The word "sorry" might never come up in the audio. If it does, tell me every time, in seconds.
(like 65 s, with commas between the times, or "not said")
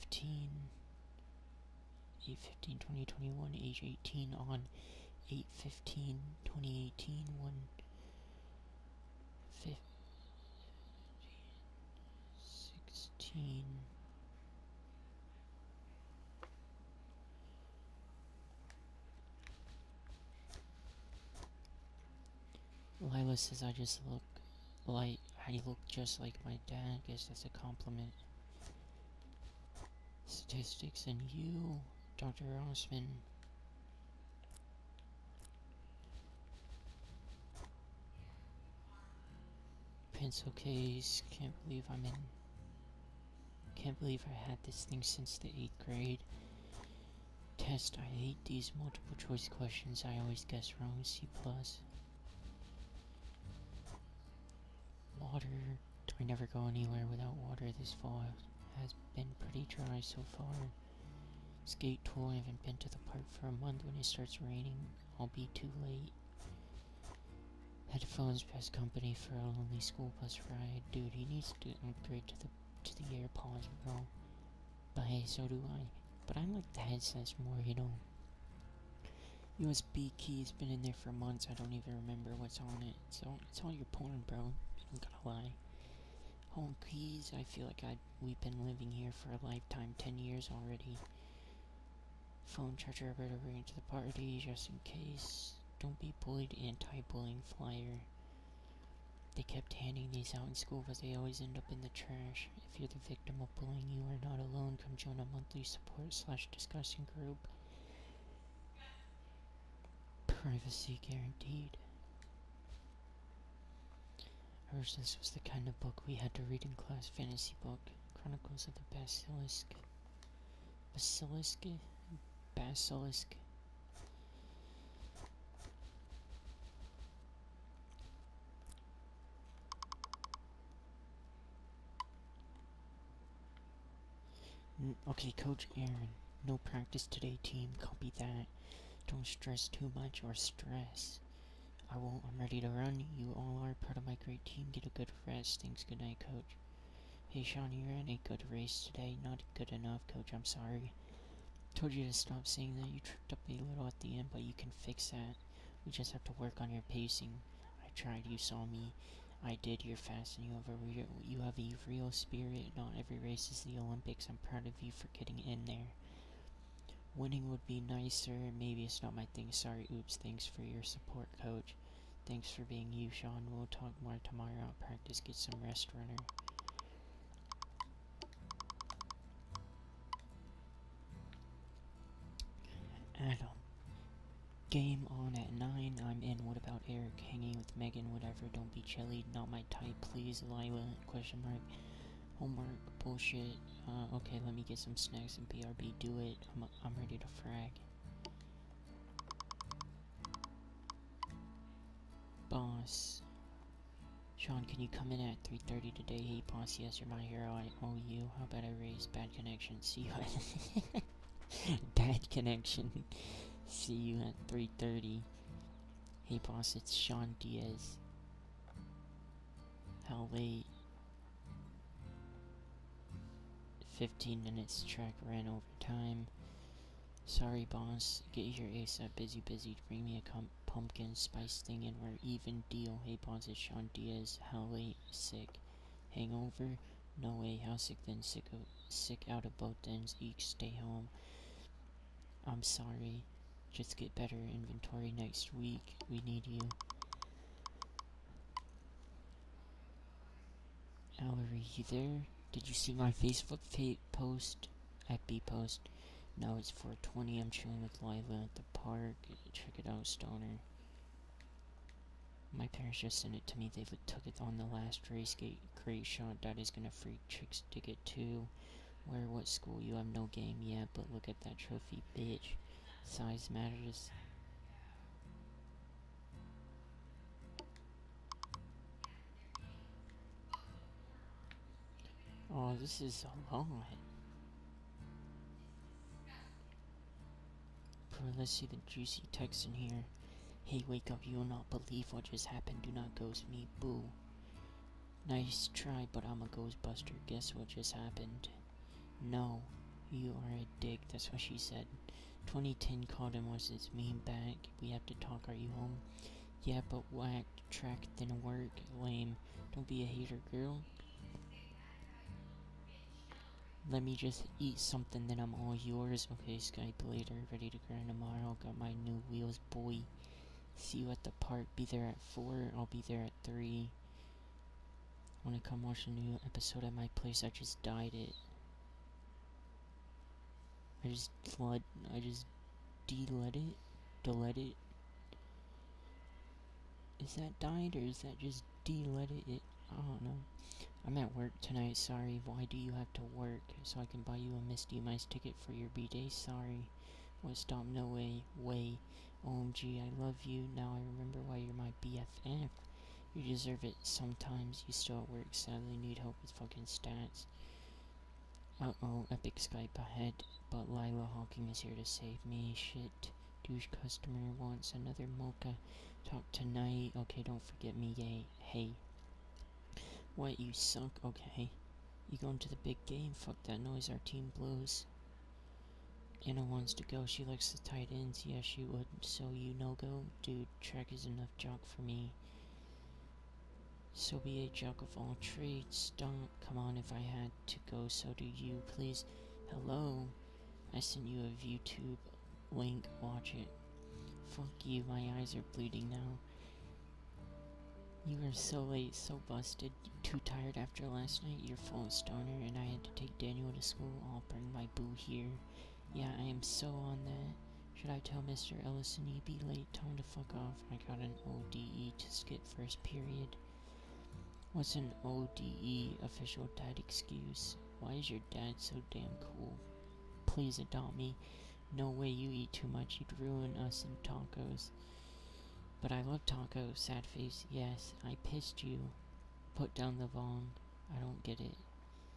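150 s, 169 s, 227 s, 242 s, 341 s, 346 s.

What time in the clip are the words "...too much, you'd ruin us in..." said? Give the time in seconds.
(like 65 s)
422 s.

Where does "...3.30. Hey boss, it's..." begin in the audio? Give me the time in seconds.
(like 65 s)
214 s.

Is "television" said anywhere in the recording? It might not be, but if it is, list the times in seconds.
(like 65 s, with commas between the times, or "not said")
not said.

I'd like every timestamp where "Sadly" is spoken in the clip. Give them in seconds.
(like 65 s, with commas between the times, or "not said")
355 s.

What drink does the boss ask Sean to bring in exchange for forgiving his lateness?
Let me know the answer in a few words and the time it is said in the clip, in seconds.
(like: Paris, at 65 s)
pumpkin spice, at 230 s.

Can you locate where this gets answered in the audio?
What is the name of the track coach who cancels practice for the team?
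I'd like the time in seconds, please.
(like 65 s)
135 s.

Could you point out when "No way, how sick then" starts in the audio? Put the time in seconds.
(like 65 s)
237 s.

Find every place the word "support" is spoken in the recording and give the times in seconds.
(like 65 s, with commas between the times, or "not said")
105 s, 170 s.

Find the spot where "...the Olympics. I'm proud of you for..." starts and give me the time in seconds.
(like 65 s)
163 s.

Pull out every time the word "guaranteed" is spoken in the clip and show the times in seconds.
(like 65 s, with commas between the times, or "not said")
111 s.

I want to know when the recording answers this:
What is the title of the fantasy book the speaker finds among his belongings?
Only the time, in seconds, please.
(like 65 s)
118 s.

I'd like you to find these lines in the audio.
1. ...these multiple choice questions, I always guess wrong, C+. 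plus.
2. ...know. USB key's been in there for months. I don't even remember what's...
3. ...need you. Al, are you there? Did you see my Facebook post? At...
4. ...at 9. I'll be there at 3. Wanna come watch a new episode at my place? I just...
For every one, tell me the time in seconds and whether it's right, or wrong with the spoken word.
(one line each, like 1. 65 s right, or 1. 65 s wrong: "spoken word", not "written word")
1. 48 s right
2. 77 s right
3. 246 s right
4. 322 s wrong: "4", not "9".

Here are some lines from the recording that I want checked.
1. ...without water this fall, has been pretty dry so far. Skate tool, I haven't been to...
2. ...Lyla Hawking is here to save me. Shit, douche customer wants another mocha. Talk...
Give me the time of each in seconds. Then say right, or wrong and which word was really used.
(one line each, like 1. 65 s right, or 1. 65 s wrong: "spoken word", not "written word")
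1. 57 s right
2. 360 s right.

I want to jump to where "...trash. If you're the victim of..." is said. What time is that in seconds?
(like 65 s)
101 s.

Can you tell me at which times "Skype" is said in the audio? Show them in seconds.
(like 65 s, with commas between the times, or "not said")
316 s, 359 s.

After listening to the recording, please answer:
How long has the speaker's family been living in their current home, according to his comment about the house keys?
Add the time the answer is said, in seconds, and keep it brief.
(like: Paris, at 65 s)
10 years, at 89 s.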